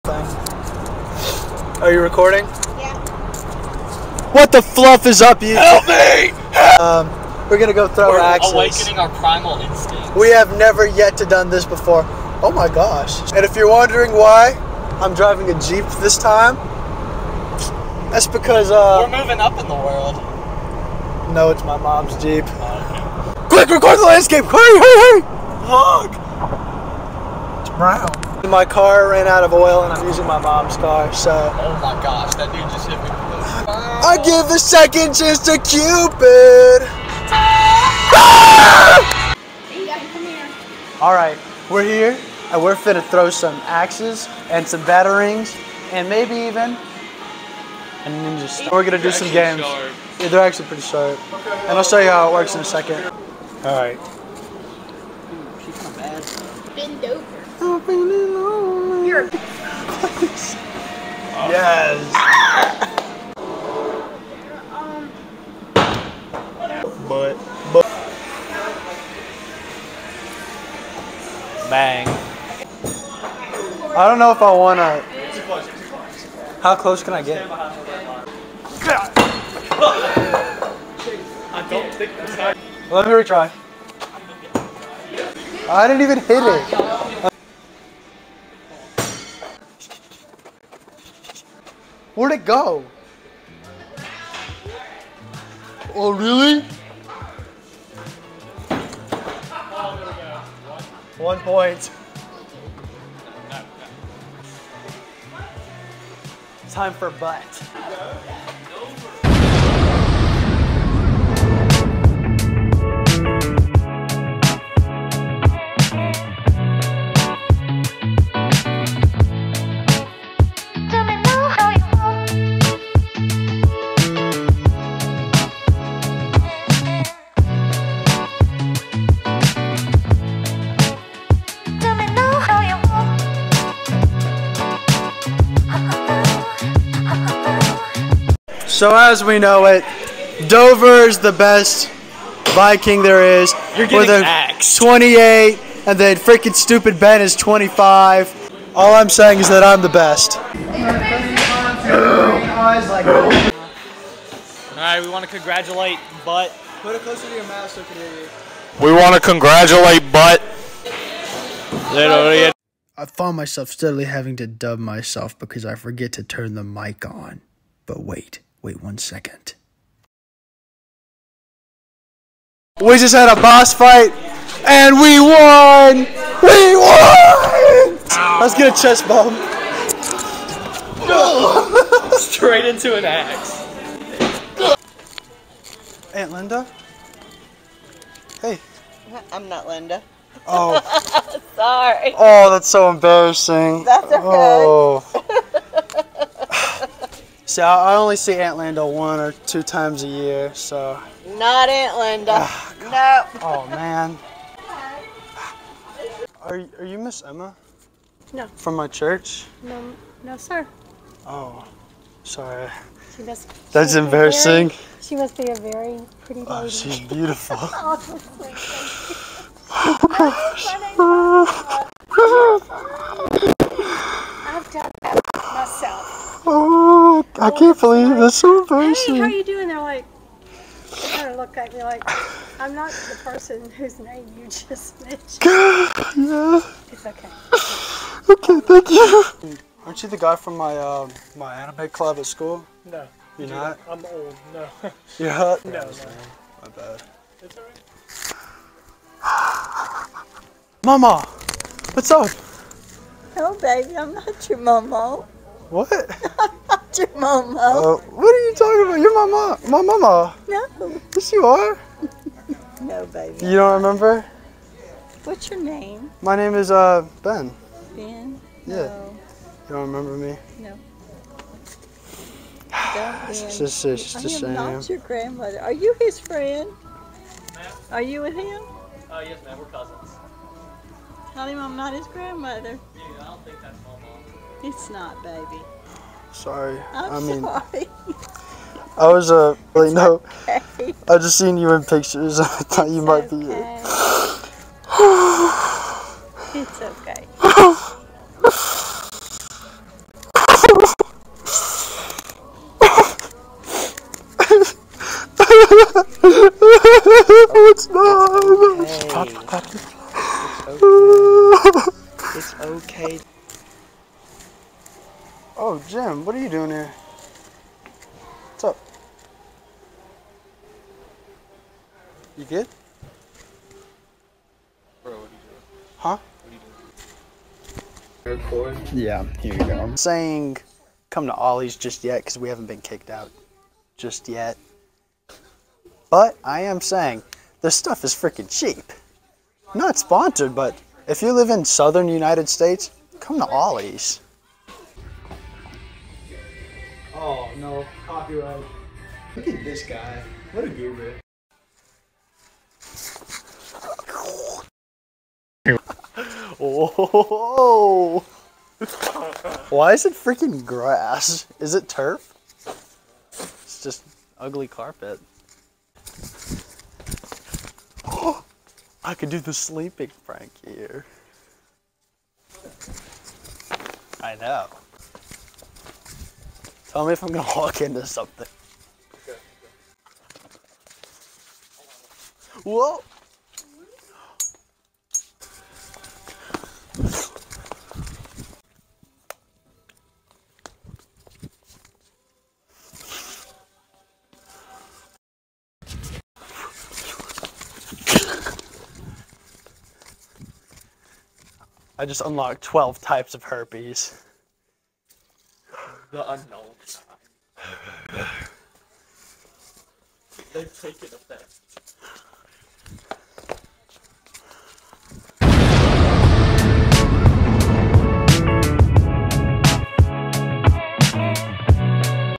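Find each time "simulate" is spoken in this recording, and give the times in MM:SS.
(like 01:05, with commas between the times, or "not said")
not said.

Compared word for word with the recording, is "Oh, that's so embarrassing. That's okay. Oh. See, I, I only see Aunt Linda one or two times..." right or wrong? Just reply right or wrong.
right.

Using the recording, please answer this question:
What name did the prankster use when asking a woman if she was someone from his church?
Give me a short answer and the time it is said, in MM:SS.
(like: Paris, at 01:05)
Miss Emma, at 03:26.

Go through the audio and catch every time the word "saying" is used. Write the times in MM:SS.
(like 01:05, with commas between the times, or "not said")
02:29, 05:29, 05:36.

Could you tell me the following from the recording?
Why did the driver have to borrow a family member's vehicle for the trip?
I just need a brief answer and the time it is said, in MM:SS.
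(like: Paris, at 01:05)
Car ran out of oil, at 00:29.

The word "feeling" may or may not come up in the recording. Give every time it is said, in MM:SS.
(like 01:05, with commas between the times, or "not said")
00:57.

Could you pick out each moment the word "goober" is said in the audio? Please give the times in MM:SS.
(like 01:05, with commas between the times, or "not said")
05:50.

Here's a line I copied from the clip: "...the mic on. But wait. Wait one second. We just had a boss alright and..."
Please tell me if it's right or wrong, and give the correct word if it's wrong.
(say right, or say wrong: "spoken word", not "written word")
wrong: "fight", not "alright".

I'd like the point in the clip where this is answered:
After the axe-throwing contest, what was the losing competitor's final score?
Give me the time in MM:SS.
02:27.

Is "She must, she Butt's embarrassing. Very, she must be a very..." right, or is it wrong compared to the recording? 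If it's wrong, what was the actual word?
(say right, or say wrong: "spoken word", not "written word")
wrong: "That", not "Butt".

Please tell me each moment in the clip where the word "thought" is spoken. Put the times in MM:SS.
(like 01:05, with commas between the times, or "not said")
04:52.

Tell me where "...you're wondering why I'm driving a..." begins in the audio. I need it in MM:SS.
00:13.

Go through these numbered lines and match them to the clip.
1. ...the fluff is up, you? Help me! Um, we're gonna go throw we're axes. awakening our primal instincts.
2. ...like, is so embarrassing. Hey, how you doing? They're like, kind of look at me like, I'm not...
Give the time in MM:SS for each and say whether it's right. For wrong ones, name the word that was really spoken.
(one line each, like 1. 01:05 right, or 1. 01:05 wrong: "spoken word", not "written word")
1. 00:04 right
2. 03:48 right.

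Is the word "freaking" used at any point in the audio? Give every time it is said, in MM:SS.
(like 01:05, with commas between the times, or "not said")
02:26, 05:38, 06:00.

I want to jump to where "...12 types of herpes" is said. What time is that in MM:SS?
06:42.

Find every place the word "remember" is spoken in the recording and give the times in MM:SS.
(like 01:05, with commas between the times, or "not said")
04:23, 04:29.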